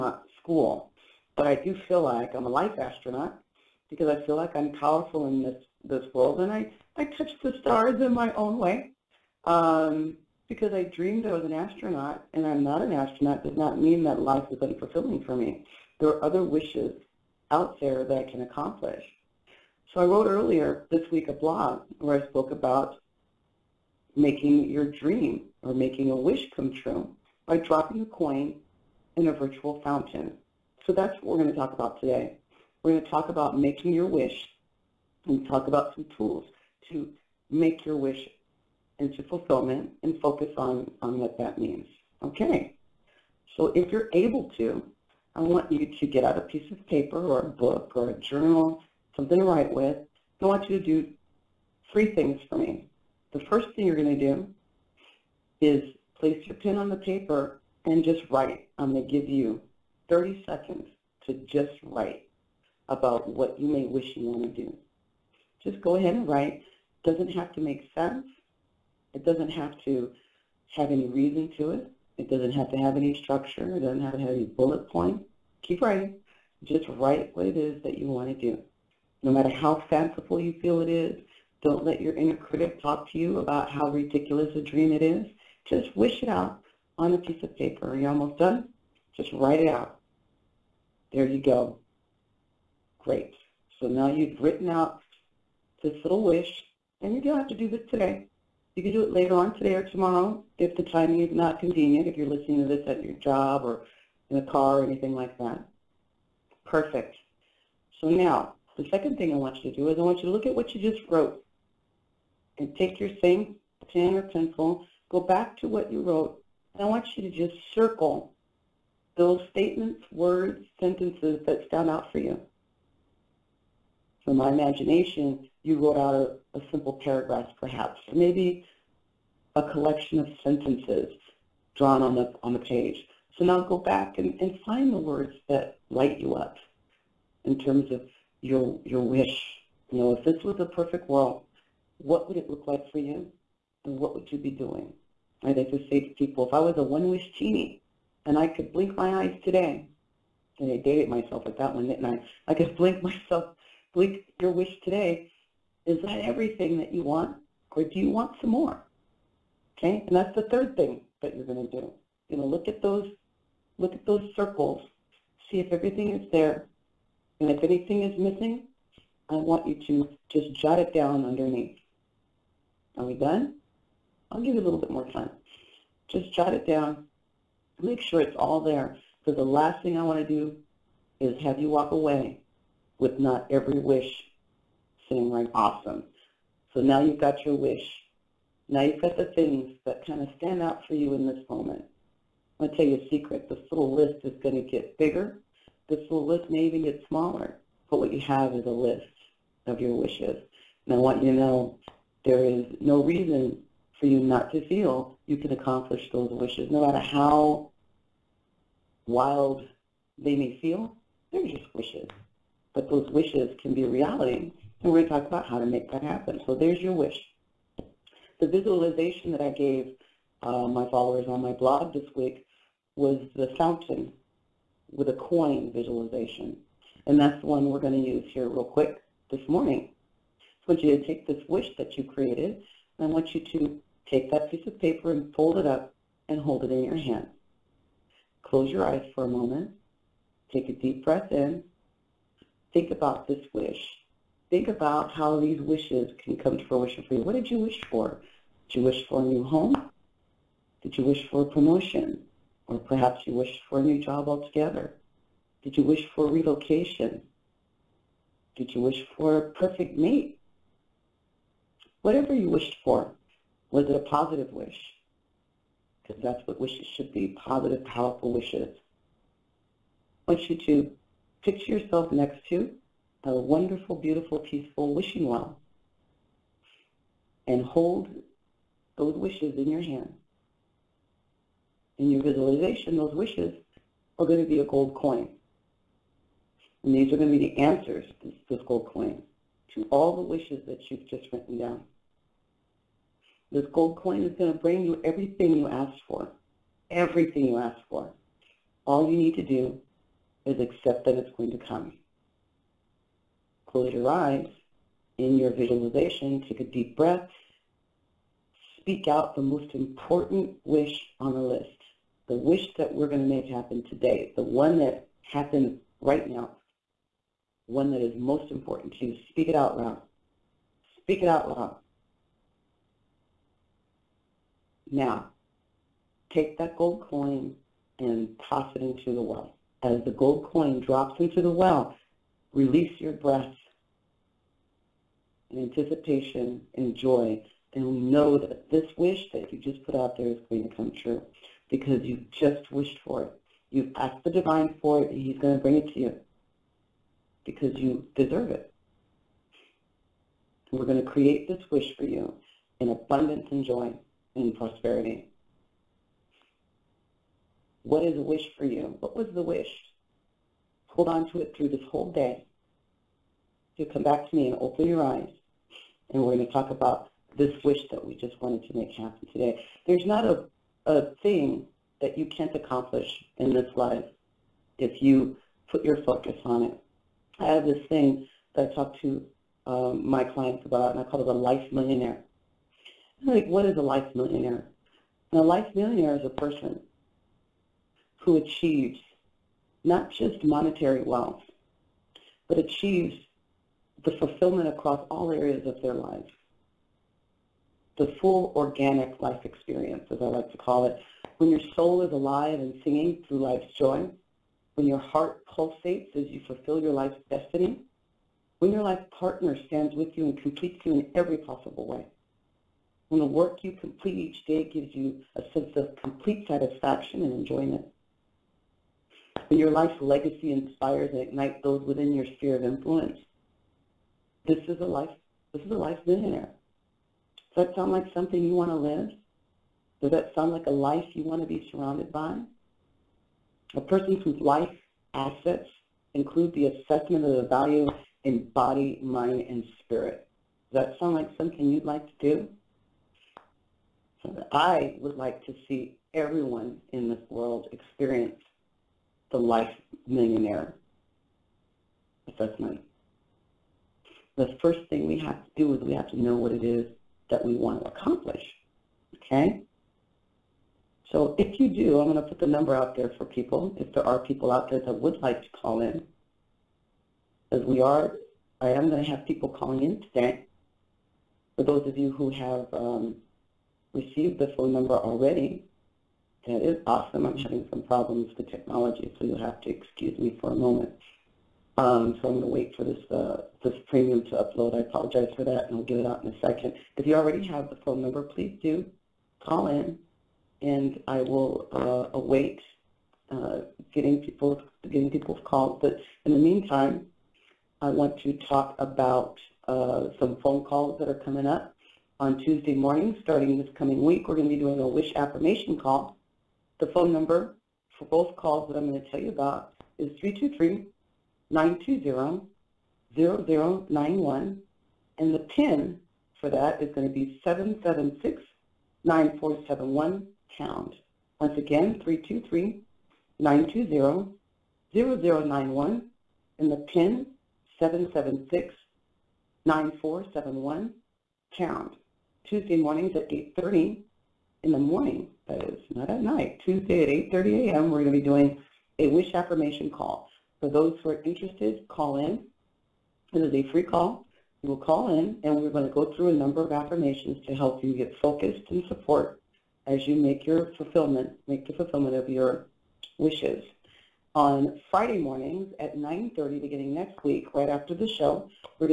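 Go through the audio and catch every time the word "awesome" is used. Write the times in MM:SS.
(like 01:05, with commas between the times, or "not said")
03:05, 07:56.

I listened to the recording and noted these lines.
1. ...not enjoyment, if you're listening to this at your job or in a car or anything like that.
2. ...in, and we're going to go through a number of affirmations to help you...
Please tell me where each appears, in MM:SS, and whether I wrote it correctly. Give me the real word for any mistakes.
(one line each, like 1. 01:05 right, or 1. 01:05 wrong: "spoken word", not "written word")
1. 01:41 wrong: "convenient", not "enjoyment"
2. 09:05 right.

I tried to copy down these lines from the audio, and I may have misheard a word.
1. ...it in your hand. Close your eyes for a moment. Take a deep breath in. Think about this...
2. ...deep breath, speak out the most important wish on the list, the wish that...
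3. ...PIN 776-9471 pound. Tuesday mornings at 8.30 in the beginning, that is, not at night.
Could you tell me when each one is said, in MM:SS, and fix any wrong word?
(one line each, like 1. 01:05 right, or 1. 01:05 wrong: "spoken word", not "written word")
1. 03:56 right
2. 05:06 right
3. 08:46 wrong: "morning", not "beginning".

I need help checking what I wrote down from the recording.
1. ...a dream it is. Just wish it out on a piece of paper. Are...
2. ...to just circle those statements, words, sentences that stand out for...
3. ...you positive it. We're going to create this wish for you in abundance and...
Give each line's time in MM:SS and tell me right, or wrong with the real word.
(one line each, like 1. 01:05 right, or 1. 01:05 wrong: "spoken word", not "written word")
1. 01:24 right
2. 01:57 right
3. 05:47 wrong: "deserve", not "positive".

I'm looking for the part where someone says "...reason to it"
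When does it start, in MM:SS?
01:11.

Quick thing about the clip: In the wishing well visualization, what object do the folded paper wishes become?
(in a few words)
a gold coin.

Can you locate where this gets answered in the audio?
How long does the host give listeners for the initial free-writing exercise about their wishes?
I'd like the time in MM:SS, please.
01:00.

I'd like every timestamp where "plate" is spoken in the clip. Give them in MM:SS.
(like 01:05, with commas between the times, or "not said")
not said.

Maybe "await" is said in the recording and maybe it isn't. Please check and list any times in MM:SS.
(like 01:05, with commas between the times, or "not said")
08:12.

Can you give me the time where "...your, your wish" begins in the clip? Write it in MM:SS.
02:18.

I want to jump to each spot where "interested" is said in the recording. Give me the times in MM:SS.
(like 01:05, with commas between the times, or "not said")
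09:01.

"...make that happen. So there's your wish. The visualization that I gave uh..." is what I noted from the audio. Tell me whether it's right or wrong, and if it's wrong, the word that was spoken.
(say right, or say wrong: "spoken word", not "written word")
right.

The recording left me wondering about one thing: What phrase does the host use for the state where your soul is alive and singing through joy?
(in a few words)
organic life experience.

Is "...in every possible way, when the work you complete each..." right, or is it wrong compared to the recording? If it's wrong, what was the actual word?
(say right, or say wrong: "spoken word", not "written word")
right.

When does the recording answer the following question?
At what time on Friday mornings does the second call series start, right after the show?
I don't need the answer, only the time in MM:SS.
09:15.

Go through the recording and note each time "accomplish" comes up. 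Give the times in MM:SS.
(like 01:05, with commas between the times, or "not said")
00:18, 03:25, 06:12, 07:37.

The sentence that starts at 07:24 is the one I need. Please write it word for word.
So I would like to see everyone in this world experience the Life Millionaire Assessment.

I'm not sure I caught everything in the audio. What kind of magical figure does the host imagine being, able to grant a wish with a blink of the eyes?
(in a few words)
one-wish genie.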